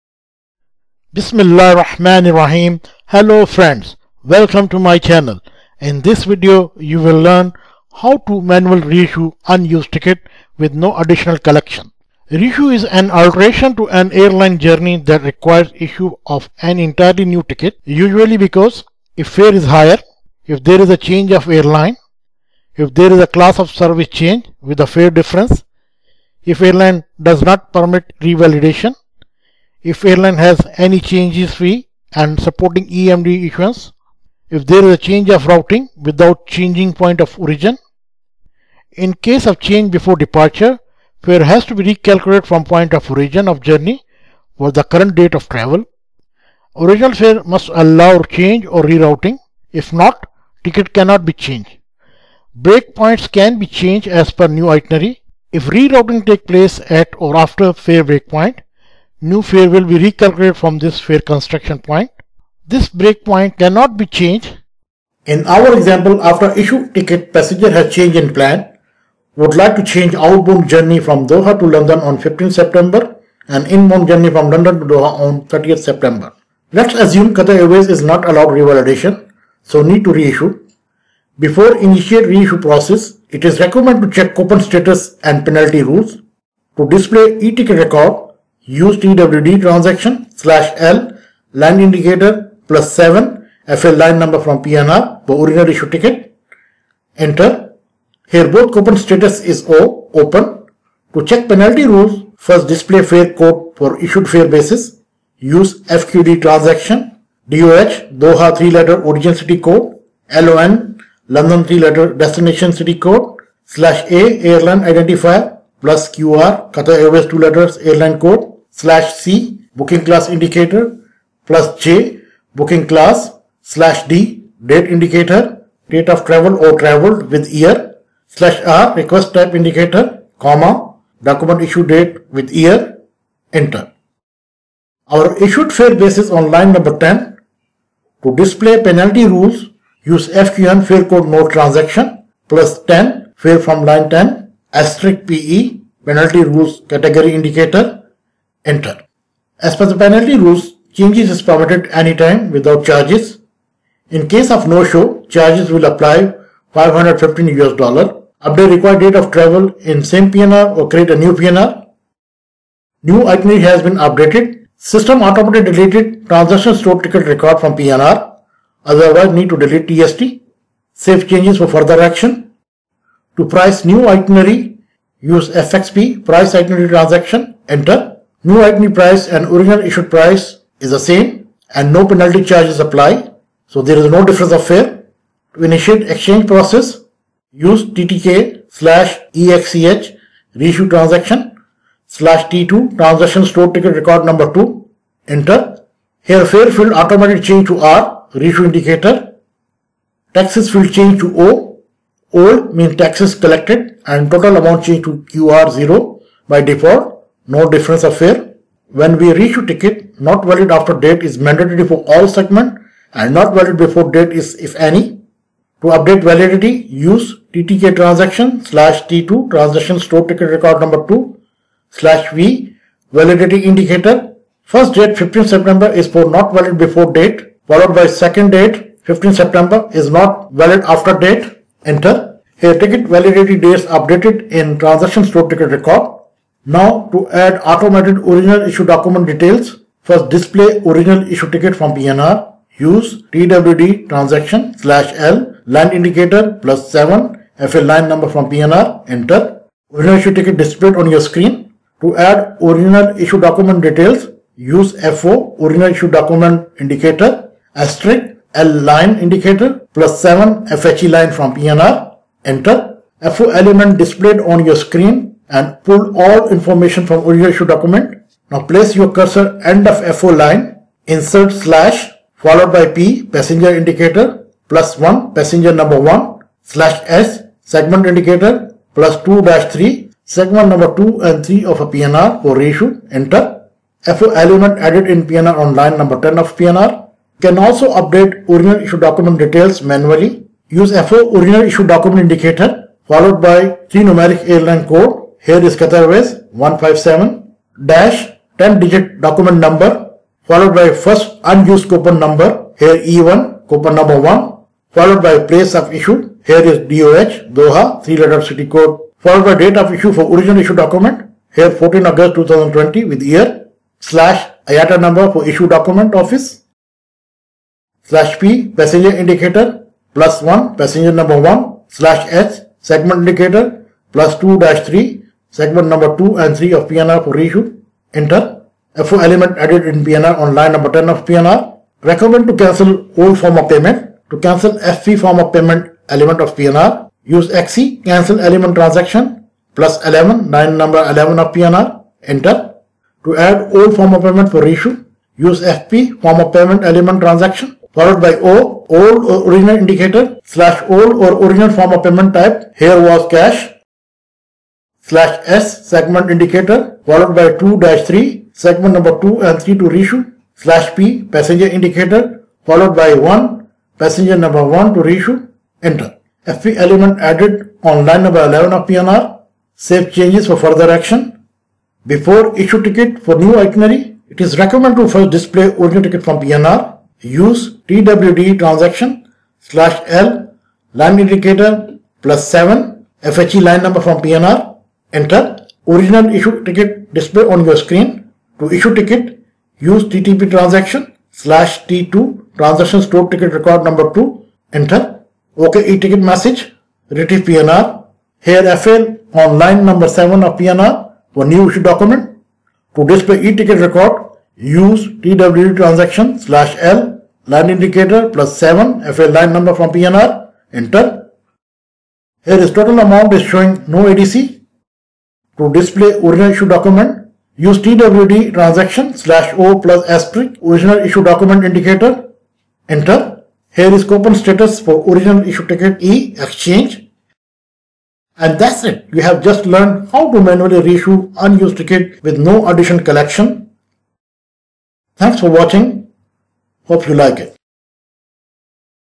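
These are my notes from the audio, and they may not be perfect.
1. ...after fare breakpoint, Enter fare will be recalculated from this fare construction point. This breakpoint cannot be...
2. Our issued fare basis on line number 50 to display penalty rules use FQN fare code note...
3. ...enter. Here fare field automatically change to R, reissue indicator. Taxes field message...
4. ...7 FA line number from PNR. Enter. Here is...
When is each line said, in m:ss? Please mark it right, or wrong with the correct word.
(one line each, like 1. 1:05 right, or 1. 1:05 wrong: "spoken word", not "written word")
1. 0:57 wrong: "New", not "Enter"
2. 2:15 wrong: "10", not "50"
3. 3:15 wrong: "change", not "message"
4. 6:48 right.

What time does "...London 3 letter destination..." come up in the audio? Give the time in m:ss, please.
1:51.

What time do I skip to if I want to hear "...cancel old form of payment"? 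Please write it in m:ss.
5:32.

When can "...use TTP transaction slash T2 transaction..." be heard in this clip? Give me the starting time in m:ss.
6:29.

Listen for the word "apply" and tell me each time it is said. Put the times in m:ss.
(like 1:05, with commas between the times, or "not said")
2:35, 3:02.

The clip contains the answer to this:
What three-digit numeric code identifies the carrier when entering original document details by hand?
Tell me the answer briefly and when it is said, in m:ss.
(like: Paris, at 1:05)
157, at 4:56.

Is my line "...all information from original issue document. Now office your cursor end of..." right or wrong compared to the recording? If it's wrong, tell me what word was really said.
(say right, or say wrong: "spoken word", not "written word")
wrong: "place", not "office".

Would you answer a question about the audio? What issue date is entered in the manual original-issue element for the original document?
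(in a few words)
14 August 2020.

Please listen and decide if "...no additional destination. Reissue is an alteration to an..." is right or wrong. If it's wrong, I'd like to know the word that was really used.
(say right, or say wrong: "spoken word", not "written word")
wrong: "collection", not "destination".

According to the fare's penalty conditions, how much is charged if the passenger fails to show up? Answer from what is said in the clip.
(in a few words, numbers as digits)
515 US dollars.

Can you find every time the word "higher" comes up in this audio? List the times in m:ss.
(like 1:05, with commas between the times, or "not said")
0:19.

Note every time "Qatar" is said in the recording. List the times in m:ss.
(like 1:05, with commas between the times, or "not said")
1:17, 1:56, 4:55.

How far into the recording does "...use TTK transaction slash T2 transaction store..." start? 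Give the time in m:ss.
3:36.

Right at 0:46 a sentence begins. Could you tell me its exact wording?
Original fare must allow change or rerouting.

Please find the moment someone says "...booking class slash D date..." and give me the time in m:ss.
2:02.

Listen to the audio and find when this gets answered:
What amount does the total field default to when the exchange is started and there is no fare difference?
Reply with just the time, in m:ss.
3:25.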